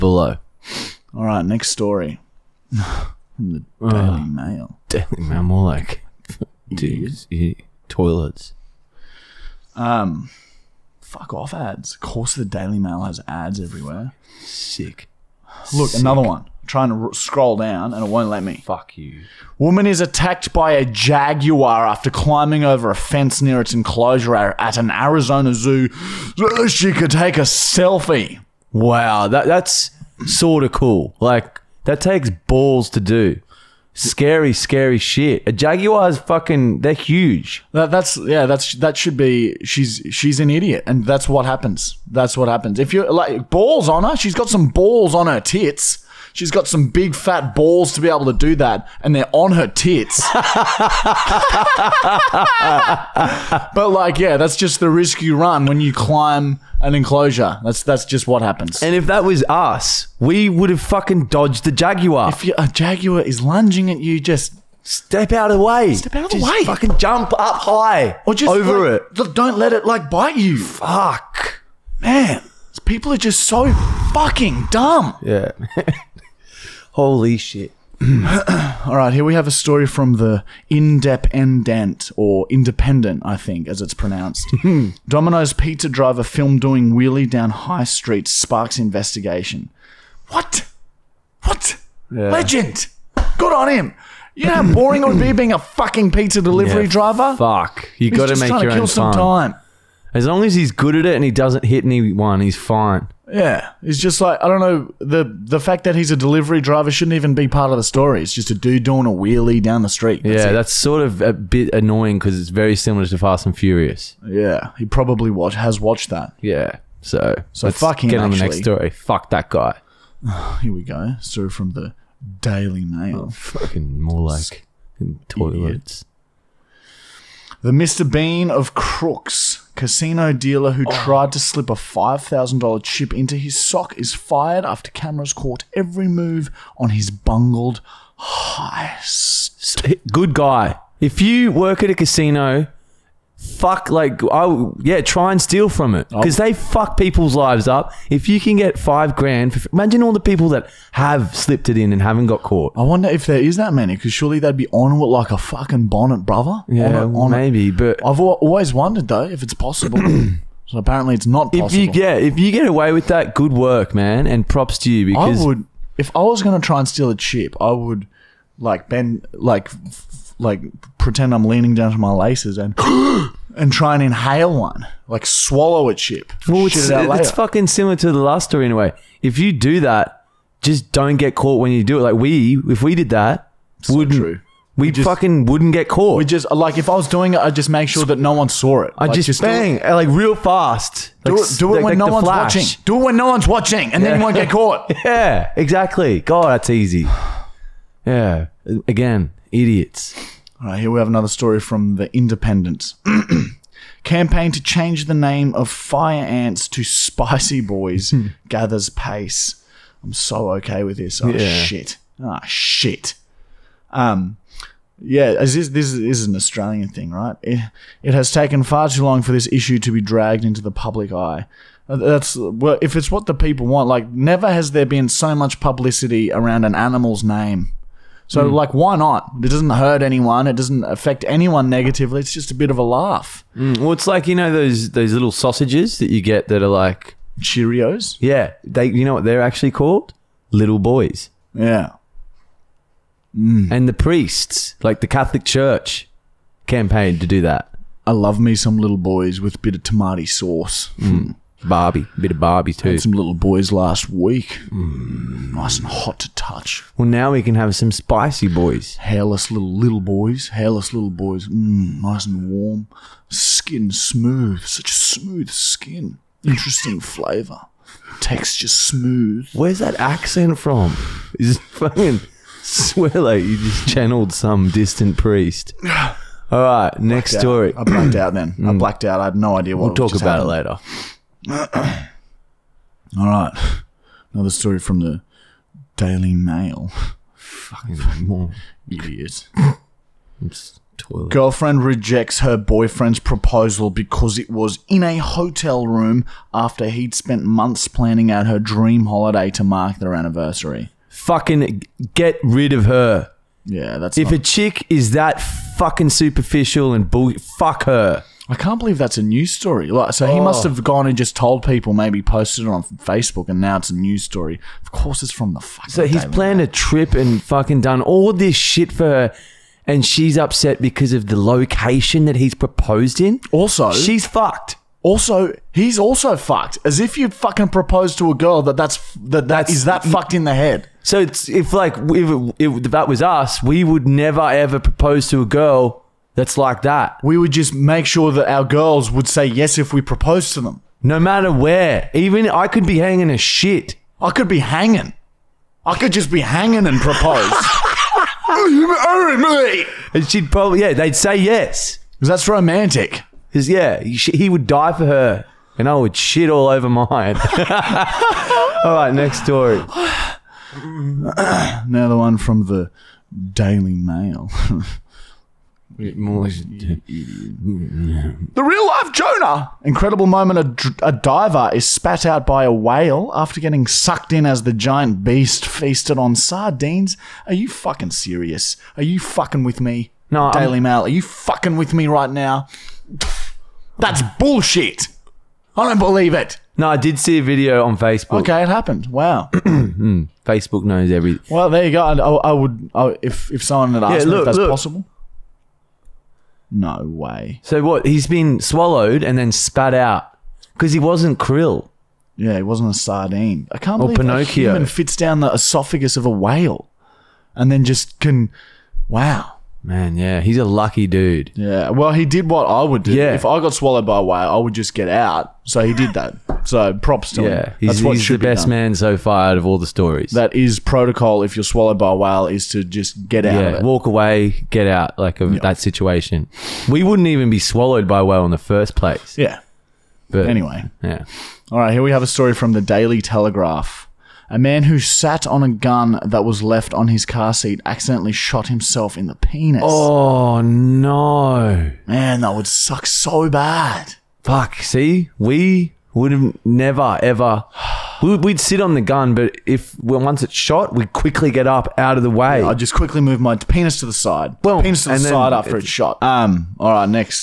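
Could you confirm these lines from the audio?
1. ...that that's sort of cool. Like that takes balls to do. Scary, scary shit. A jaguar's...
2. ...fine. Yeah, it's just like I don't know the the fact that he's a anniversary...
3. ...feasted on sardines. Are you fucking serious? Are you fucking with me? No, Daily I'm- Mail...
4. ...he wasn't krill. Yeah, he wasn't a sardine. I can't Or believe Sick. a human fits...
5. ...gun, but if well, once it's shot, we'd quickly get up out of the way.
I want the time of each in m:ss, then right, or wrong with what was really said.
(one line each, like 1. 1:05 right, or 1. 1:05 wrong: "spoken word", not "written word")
1. 0:29 right
2. 1:42 wrong: "delivery", not "anniversary"
3. 6:15 right
4. 6:40 wrong: "Pinocchio", not "Sick"
5. 7:29 right.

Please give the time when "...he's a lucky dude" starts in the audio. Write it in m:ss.
6:50.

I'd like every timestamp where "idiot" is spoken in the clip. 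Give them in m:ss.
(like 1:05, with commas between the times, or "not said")
0:40, 3:19, 4:48.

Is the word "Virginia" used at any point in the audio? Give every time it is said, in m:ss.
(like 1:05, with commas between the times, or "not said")
not said.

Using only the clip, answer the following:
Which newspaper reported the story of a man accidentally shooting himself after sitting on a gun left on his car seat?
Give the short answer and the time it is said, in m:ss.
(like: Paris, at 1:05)
Daily Telegraph, at 7:12.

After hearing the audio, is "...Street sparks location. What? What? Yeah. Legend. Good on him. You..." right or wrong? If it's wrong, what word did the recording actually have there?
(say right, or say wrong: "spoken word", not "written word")
wrong: "investigation", not "location".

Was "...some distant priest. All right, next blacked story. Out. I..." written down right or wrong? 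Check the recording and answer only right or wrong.
right.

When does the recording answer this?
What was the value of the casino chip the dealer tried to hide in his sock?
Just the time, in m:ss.
2:11.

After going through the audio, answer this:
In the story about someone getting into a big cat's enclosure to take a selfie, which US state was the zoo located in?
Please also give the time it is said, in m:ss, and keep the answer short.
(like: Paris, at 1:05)
Arizona, at 0:24.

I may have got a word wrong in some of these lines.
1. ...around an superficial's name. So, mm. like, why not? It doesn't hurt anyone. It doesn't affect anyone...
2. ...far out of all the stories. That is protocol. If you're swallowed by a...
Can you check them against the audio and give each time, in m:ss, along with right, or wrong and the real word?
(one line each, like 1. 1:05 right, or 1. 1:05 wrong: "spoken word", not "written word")
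1. 3:46 wrong: "animal", not "superficial"
2. 6:59 right.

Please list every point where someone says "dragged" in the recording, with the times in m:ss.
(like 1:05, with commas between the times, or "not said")
3:40.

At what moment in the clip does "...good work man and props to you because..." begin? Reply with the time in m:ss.
2:43.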